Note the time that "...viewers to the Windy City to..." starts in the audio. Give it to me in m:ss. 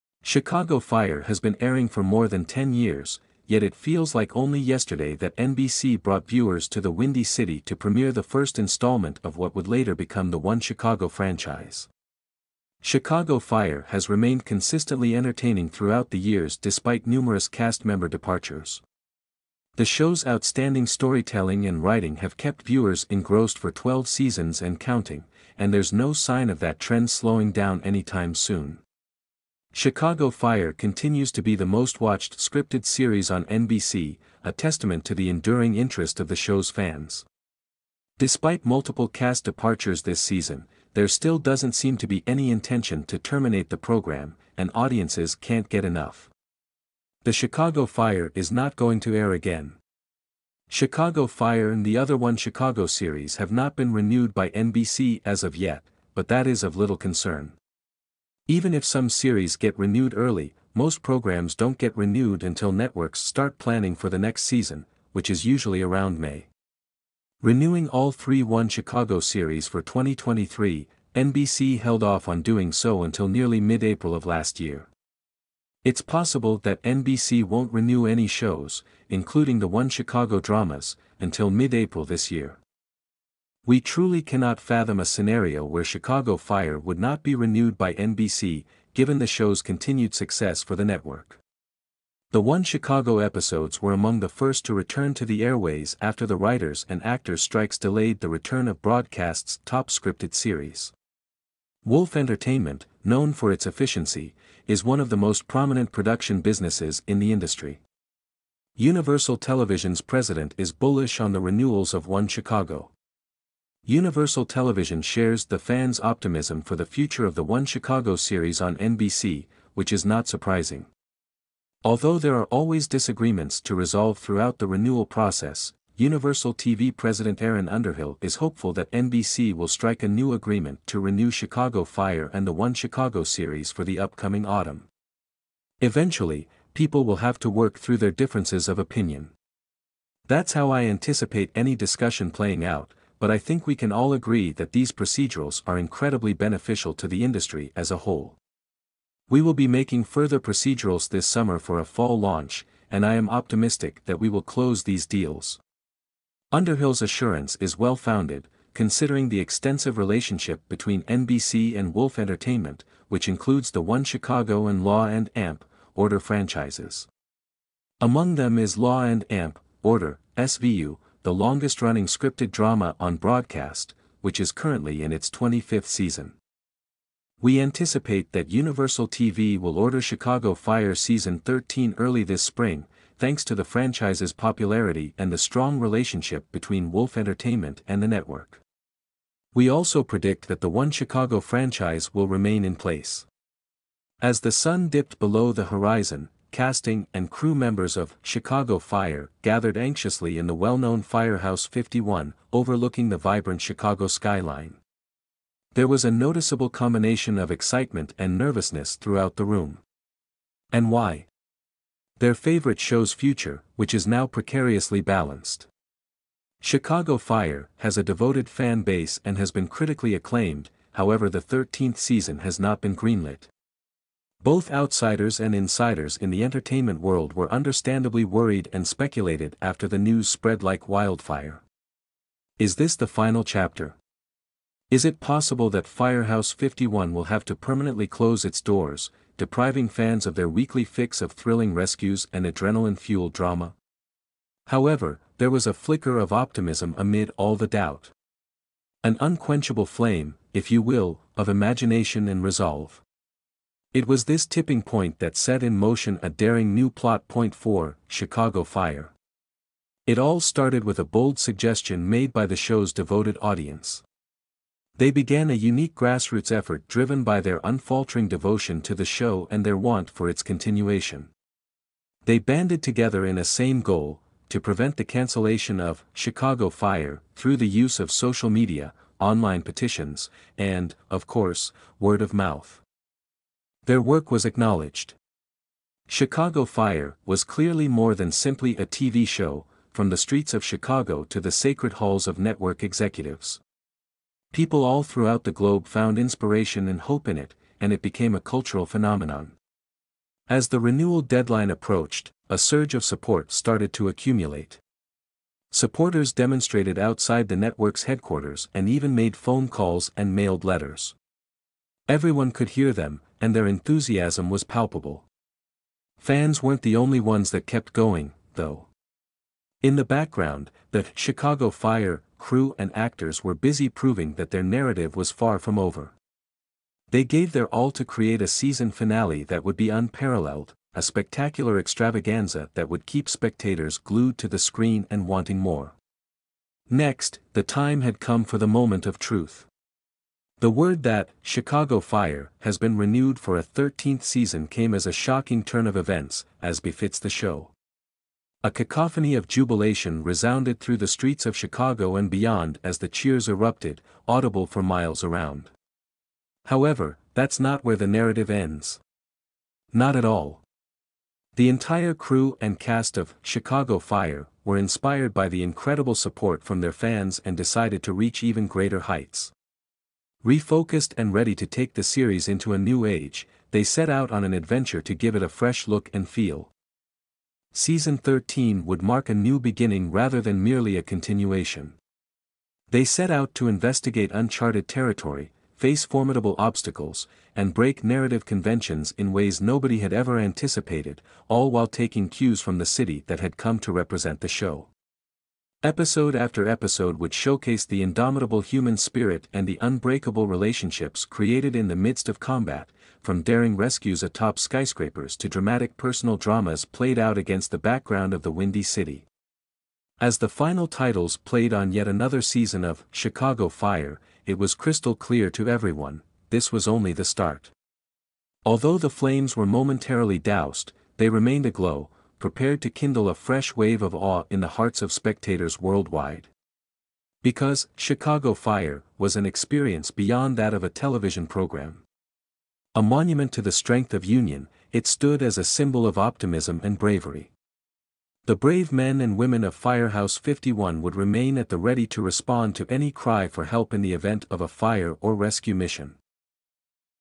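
0:06.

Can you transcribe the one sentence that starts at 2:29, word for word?
We will be making further procedurals this summer for a fall launch, and I am optimistic that we will close these deals.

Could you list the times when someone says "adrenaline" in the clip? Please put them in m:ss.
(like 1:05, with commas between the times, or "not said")
4:02.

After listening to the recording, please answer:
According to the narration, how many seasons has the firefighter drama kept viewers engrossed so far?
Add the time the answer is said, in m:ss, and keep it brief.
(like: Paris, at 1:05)
12, at 0:23.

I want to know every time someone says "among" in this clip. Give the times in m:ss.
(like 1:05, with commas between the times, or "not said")
1:33, 2:47.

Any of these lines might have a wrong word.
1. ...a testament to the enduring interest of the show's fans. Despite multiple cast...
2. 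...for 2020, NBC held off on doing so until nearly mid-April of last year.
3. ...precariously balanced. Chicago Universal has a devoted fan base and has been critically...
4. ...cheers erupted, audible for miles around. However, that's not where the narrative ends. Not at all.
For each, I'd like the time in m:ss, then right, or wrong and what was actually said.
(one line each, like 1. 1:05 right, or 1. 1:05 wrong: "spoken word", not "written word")
1. 0:34 right
2. 1:09 wrong: "2023", not "2020"
3. 3:34 wrong: "Fire", not "Universal"
4. 5:53 right.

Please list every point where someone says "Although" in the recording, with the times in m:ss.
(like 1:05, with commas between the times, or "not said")
2:01, 6:58.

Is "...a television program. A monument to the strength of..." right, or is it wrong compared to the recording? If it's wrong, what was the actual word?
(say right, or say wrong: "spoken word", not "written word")
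right.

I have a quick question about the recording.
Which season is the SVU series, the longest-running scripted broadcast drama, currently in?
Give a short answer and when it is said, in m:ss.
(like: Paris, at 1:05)
25th, at 2:55.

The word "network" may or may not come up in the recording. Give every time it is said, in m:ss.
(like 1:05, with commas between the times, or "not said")
1:02, 1:30, 3:08, 4:52, 5:07.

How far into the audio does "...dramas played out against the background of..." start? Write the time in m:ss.
6:46.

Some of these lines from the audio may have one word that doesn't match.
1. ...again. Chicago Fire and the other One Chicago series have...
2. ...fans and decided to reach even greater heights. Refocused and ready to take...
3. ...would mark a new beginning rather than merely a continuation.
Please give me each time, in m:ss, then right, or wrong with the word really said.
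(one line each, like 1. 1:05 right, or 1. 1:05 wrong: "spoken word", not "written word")
1. 0:49 right
2. 6:06 right
3. 6:18 right.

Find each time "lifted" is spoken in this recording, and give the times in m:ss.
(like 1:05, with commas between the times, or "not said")
not said.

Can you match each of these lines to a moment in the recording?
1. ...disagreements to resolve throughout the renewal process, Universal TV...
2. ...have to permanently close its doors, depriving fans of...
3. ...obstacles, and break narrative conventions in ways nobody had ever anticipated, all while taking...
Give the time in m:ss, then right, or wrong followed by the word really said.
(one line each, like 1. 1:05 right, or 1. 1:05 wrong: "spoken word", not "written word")
1. 2:02 right
2. 3:57 right
3. 6:26 right.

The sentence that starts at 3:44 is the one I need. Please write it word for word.
Both outsiders and insiders in the entertainment world were understandably worried and speculated after the news spread like wildfire.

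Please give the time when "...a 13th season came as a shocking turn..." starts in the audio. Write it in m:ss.
5:43.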